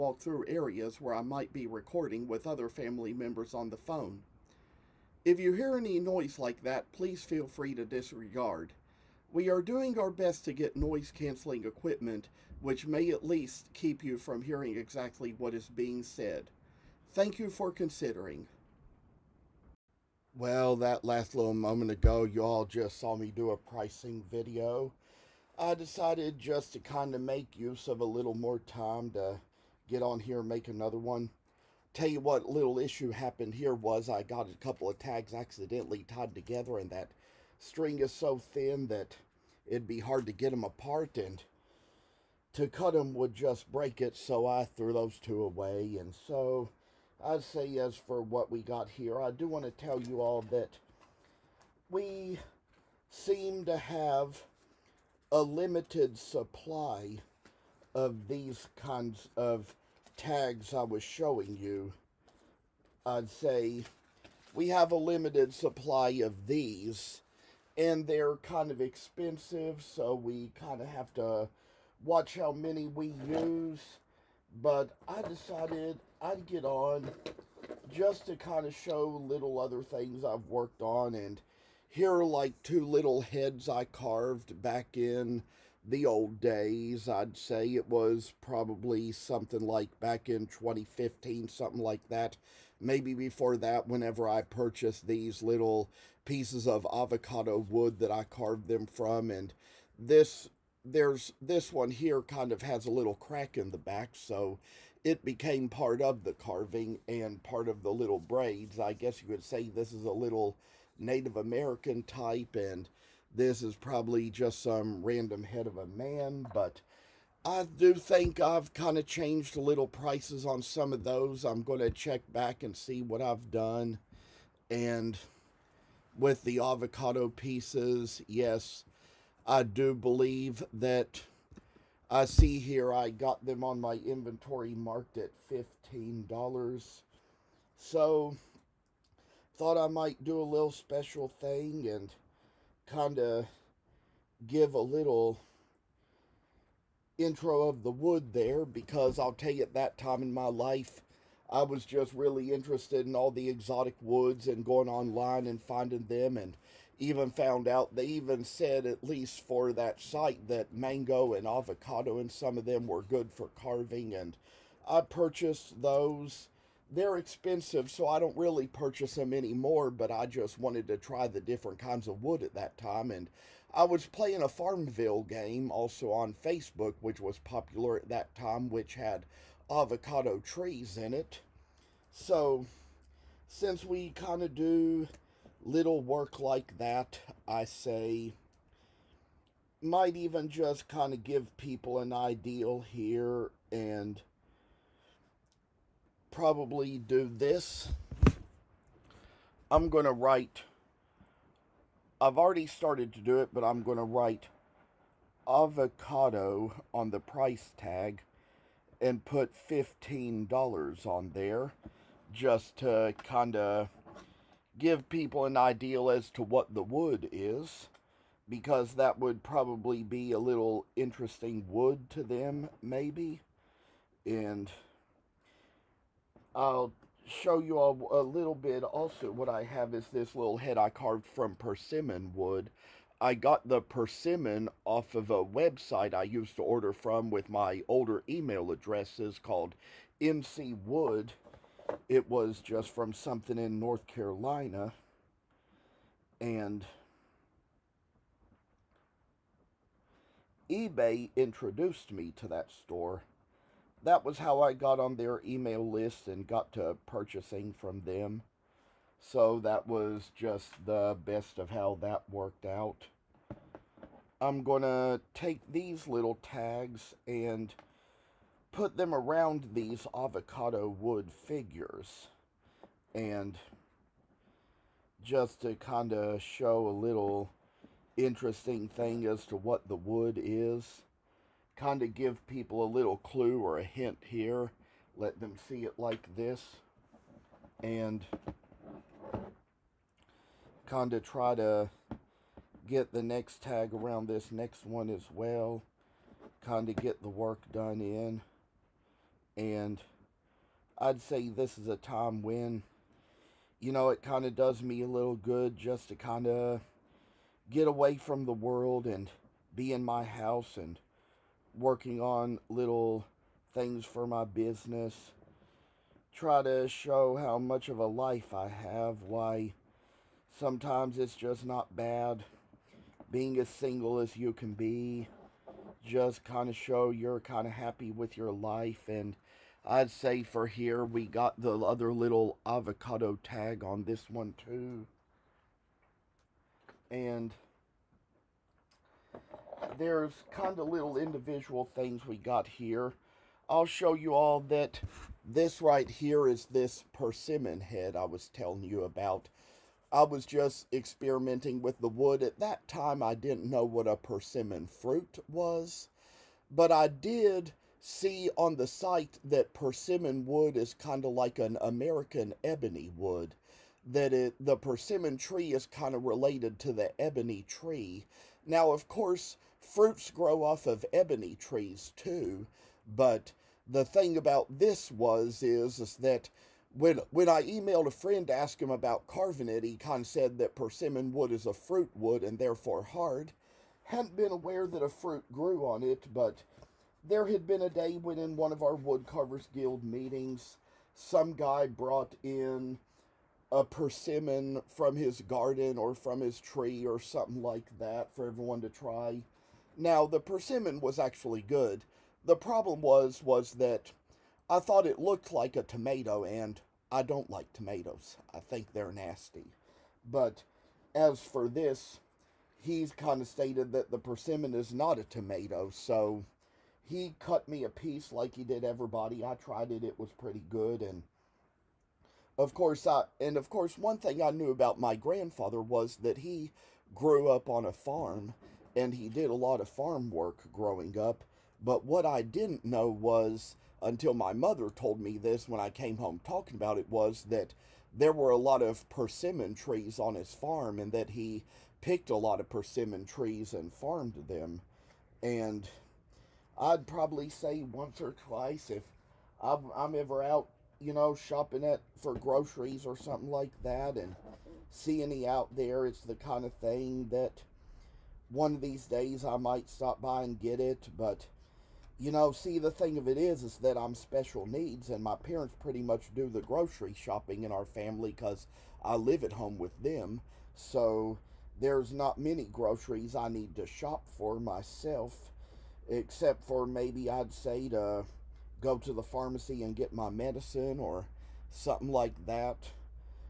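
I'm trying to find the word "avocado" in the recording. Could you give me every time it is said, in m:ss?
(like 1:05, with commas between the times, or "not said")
1:36, 2:06, 2:41, 2:59, 3:25, 4:30, 5:32.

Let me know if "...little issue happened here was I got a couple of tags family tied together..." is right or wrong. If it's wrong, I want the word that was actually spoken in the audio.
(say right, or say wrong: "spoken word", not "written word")
wrong: "accidentally", not "family".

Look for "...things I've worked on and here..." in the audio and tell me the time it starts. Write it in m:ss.
1:19.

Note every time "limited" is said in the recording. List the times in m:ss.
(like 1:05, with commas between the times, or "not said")
0:55, 1:04.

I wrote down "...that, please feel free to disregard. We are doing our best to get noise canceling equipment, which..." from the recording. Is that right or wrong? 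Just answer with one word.
right.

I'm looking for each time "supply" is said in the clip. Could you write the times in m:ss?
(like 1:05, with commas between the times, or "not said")
0:56, 1:05.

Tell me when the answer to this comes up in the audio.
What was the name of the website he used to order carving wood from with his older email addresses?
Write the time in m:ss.
4:00.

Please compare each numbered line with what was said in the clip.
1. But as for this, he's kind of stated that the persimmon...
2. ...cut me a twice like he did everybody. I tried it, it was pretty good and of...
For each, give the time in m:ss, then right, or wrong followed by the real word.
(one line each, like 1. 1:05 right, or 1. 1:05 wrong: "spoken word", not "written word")
1. 6:50 right
2. 6:57 wrong: "piece", not "twice".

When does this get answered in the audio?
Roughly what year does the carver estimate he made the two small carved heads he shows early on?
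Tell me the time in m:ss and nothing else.
1:30.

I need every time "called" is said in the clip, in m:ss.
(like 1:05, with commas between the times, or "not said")
3:59.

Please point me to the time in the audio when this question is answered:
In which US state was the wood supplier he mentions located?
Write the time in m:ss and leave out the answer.
4:03.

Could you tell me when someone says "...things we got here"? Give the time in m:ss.
5:41.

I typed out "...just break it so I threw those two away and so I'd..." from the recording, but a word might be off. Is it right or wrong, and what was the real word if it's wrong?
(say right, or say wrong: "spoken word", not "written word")
right.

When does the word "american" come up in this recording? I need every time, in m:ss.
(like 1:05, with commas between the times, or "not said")
1:51, 6:01.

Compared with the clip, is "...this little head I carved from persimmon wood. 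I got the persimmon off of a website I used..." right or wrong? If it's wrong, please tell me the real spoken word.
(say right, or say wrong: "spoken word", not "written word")
right.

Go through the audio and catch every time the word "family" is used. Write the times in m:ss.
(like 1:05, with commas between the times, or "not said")
0:02, 7:47.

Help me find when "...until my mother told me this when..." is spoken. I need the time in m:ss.
7:14.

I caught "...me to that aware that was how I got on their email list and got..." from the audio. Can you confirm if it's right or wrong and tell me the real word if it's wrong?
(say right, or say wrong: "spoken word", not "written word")
wrong: "store", not "aware".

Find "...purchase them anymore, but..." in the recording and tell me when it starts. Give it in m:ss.
2:48.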